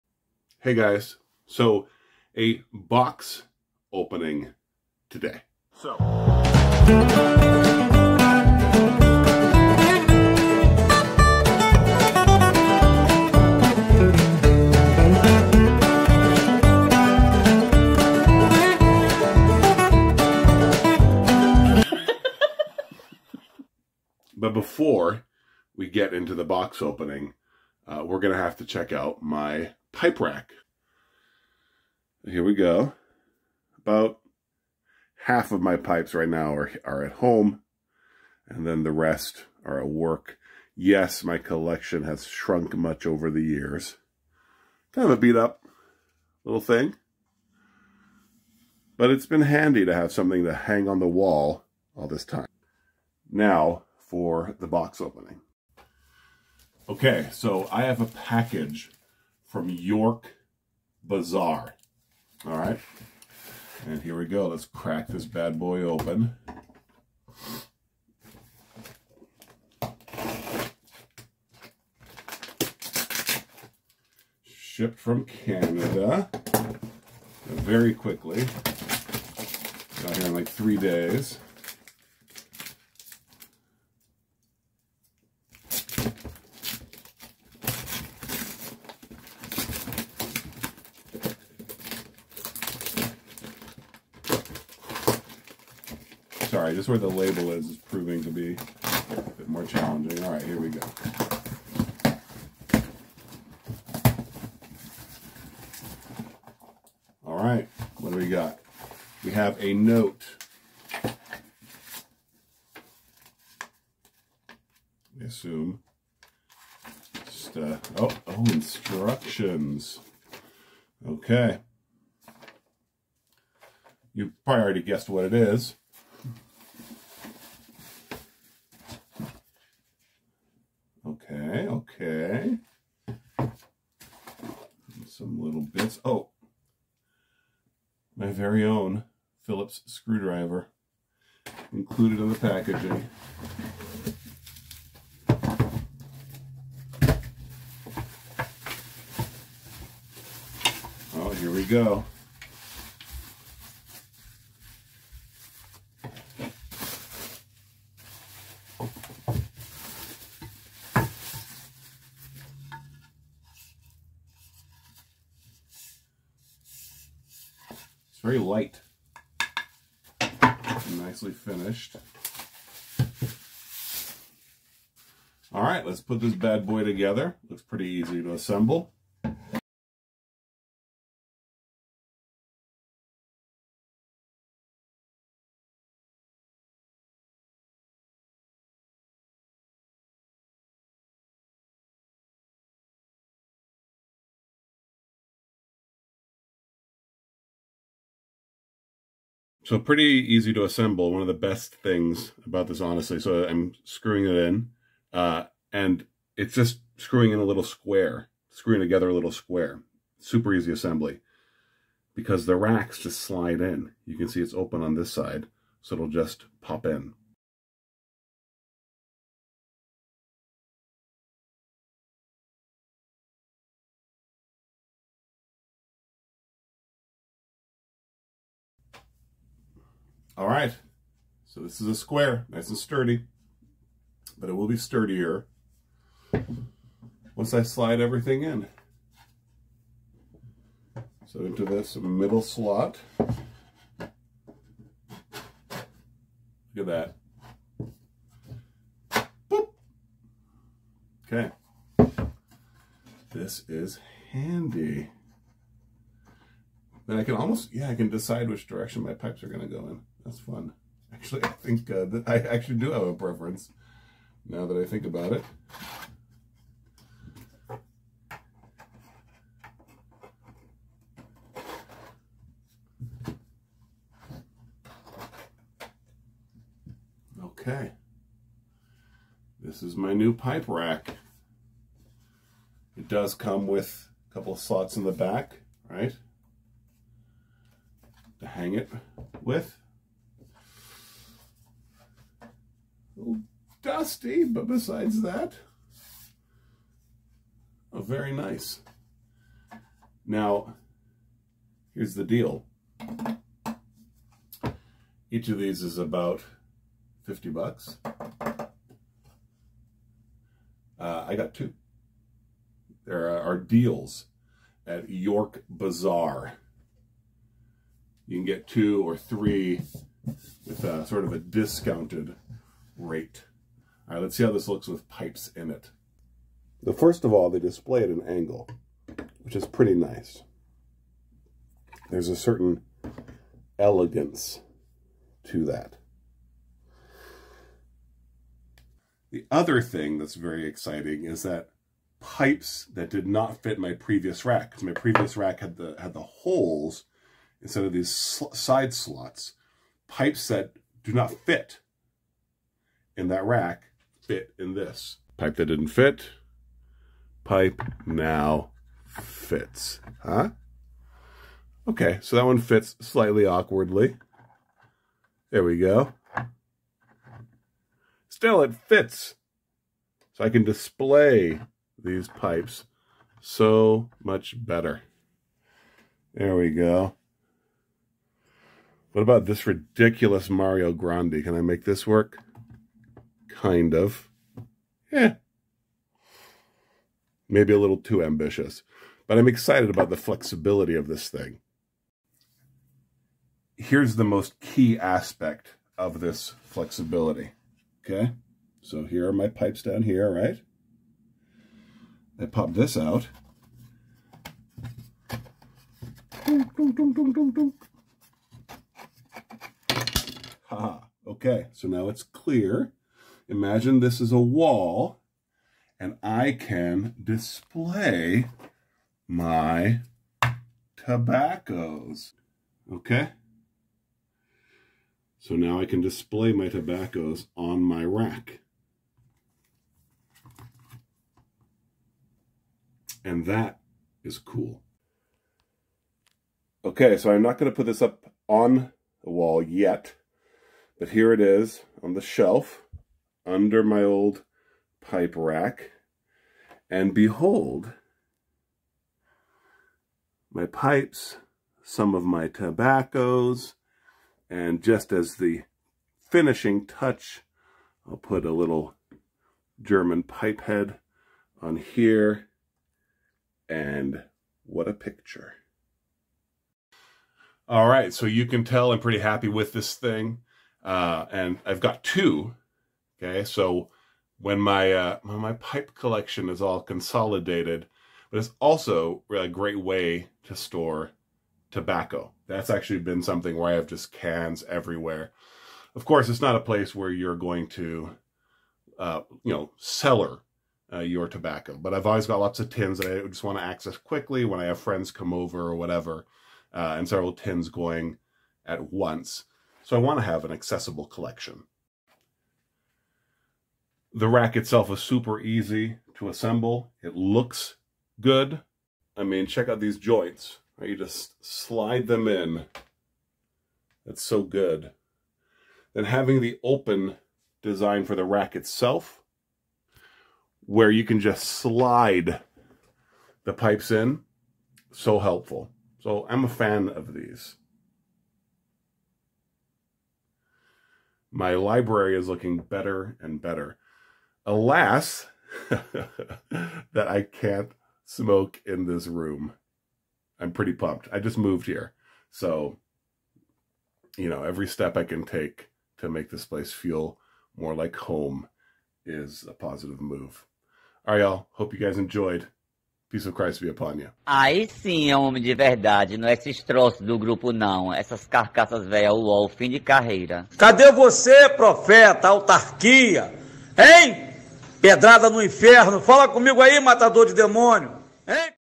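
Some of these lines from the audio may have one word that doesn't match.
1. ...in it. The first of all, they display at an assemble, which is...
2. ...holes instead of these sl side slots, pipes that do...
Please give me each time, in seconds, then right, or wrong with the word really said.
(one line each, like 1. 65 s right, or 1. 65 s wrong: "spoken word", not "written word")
1. 325 s wrong: "angle", not "assemble"
2. 346 s right.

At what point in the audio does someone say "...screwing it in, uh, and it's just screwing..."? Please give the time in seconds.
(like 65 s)
203 s.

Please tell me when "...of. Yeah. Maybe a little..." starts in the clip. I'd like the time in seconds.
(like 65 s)
383 s.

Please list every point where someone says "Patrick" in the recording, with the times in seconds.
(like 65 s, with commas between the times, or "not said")
not said.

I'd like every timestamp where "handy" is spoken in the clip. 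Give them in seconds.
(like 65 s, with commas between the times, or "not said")
49 s, 254 s.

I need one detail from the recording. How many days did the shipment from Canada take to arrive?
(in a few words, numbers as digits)
3.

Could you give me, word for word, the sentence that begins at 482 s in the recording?
That's actually been something where I have just cans everywhere.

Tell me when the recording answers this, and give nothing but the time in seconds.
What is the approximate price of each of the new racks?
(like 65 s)
307 s.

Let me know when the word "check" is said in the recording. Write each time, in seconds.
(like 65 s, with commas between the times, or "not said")
28 s, 509 s.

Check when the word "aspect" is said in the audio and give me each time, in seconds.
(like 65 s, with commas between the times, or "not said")
394 s.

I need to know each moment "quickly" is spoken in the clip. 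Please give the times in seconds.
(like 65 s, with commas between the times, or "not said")
77 s, 493 s.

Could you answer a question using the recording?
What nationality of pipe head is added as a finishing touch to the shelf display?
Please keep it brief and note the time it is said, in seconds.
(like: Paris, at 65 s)
German, at 459 s.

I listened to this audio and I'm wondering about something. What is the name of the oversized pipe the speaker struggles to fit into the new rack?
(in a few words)
Mario Grande.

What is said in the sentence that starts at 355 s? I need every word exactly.
Pipe that didn't fit, pipe now fits, huh?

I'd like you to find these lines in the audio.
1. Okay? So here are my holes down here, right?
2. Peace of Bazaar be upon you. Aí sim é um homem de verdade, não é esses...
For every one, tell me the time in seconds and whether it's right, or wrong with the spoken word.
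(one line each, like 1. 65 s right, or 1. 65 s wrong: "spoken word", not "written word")
1. 398 s wrong: "pipes", not "holes"
2. 553 s wrong: "Christ", not "Bazaar".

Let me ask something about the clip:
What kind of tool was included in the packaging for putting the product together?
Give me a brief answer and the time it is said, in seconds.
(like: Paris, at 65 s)
Phillips screwdriver, at 139 s.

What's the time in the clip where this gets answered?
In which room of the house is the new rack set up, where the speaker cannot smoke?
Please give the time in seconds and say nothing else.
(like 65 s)
531 s.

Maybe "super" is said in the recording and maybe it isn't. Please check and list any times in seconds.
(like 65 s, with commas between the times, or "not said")
210 s, 504 s.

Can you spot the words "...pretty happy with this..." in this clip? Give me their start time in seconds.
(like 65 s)
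468 s.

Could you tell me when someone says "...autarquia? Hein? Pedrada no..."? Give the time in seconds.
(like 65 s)
562 s.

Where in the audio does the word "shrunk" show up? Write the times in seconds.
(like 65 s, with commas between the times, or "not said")
42 s.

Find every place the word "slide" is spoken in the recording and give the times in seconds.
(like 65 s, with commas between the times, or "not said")
213 s, 237 s, 511 s, 521 s.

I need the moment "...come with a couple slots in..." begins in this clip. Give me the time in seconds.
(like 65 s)
283 s.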